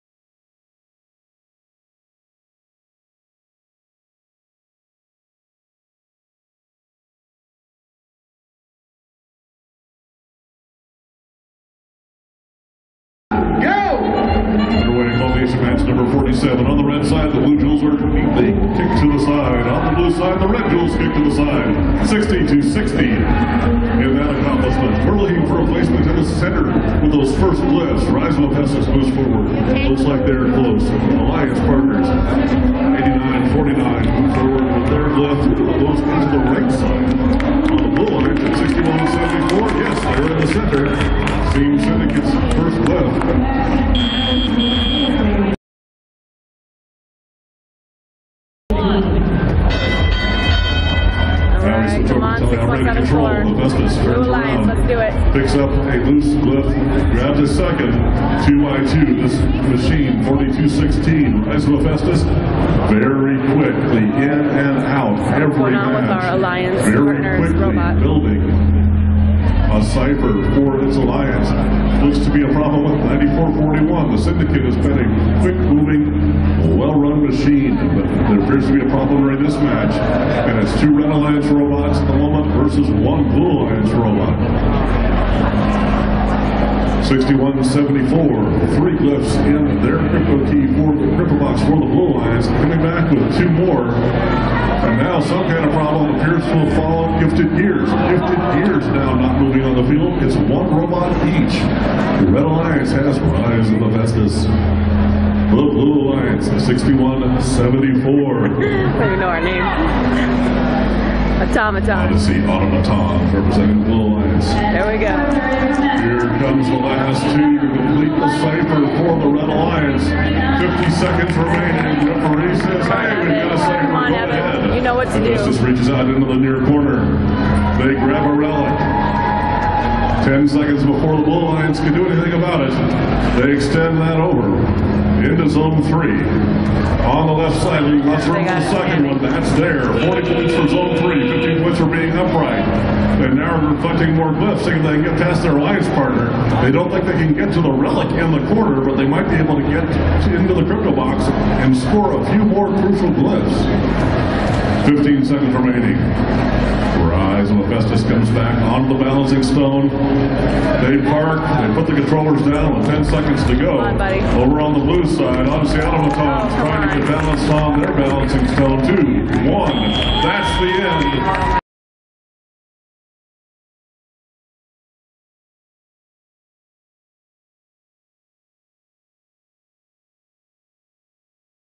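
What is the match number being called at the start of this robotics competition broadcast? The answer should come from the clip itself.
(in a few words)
47.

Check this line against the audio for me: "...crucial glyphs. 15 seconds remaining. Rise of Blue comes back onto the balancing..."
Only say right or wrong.
wrong.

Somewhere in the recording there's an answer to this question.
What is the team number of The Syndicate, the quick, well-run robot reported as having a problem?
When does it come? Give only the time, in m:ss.
1:13.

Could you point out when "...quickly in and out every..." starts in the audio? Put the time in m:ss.
1:03.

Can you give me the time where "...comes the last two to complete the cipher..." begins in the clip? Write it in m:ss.
1:56.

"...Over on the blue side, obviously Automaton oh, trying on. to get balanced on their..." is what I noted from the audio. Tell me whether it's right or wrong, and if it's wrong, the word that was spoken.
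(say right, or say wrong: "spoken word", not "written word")
right.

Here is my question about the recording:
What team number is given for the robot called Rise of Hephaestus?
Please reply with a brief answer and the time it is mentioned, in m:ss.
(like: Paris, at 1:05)
4216, at 1:00.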